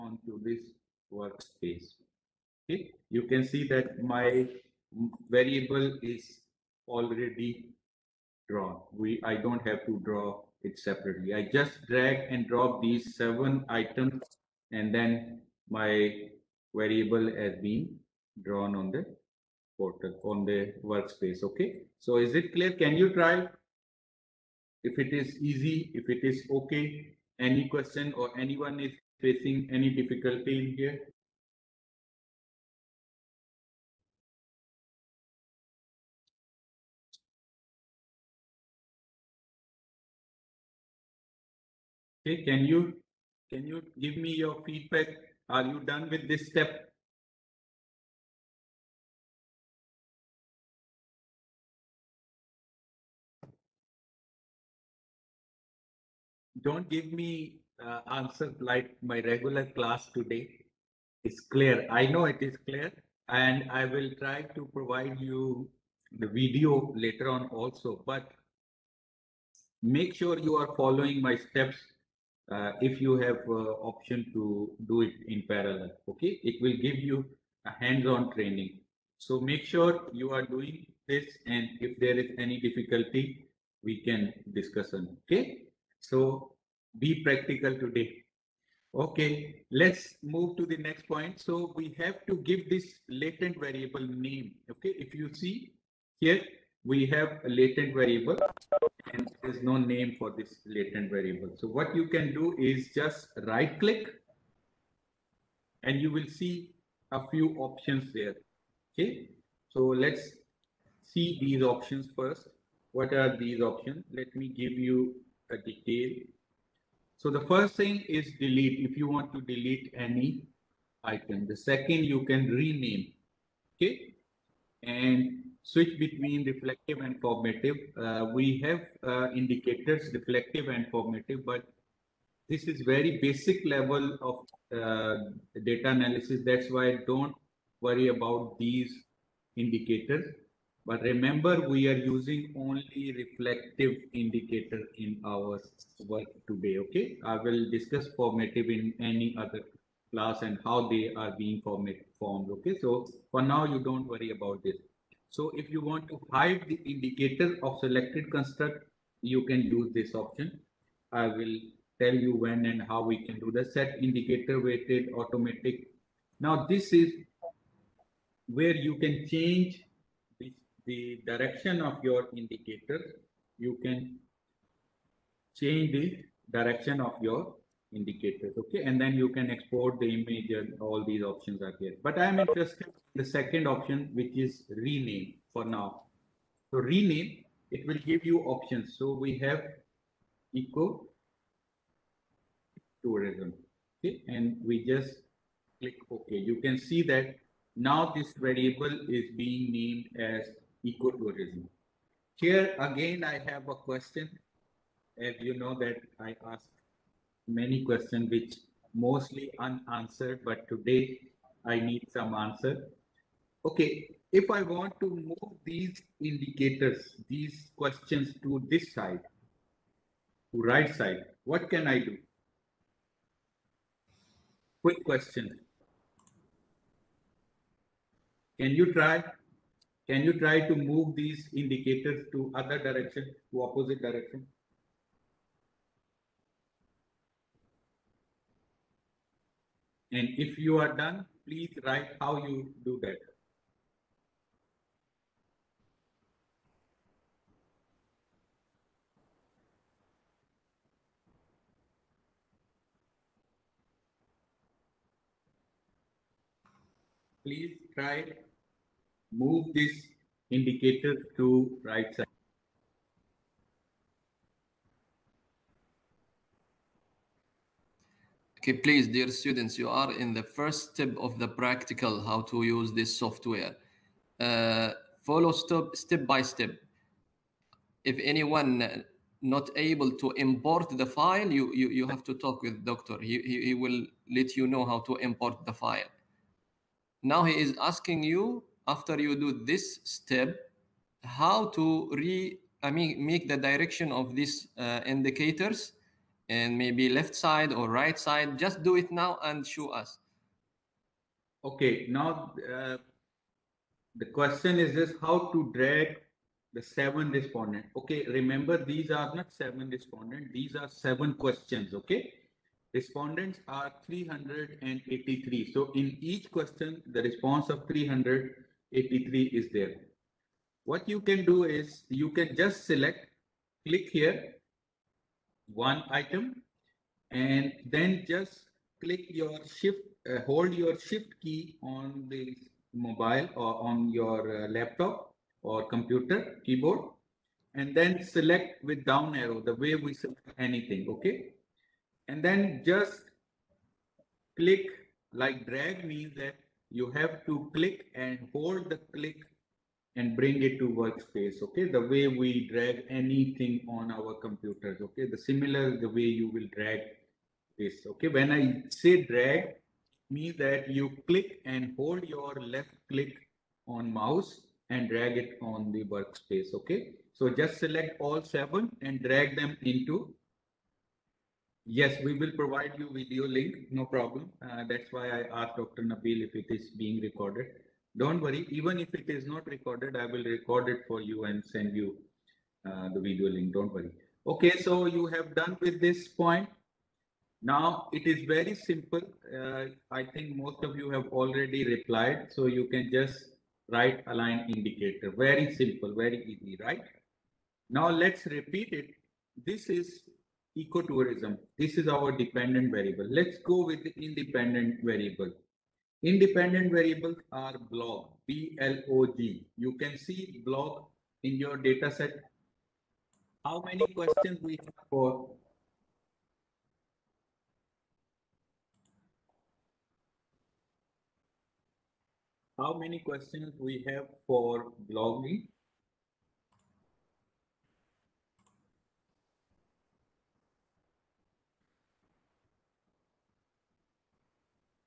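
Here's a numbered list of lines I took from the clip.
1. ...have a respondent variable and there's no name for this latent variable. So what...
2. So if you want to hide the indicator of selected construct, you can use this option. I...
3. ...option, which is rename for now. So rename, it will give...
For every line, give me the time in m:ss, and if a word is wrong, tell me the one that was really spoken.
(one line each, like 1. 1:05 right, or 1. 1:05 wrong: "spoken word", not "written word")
1. 1:37 wrong: "latent", not "respondent"
2. 2:35 right
3. 3:03 right.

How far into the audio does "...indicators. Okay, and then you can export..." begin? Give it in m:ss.
2:57.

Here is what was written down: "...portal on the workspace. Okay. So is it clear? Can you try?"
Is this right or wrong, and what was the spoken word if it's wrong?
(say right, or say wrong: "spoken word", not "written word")
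right.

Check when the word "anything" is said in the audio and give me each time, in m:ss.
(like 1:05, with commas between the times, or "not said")
5:40, 5:53.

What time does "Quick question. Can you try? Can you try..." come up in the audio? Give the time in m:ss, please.
3:44.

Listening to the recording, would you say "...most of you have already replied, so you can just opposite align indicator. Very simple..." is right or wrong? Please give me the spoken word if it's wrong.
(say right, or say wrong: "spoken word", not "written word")
wrong: "write", not "opposite".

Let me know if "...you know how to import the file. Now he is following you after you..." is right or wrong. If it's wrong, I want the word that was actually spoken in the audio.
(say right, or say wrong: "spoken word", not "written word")
wrong: "asking", not "following".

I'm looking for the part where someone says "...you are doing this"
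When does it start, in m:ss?
1:20.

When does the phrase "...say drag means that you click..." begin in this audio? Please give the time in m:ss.
5:58.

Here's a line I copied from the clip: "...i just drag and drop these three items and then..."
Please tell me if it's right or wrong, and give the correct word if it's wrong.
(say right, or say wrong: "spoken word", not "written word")
wrong: "seven", not "three".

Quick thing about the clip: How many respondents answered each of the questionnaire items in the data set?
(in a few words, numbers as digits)
383.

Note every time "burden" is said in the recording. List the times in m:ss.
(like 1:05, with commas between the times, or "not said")
not said.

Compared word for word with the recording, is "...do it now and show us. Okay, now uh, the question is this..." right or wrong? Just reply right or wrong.
right.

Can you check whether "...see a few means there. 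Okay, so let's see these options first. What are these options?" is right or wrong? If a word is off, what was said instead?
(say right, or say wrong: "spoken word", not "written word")
wrong: "options", not "means".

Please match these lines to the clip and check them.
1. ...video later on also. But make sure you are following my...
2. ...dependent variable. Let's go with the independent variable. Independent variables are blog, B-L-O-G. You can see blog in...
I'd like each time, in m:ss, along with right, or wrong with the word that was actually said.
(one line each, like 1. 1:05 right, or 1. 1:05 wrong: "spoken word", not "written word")
1. 1:06 right
2. 6:42 right.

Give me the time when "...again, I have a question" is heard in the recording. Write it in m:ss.
3:22.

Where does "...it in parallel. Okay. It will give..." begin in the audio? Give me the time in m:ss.
1:15.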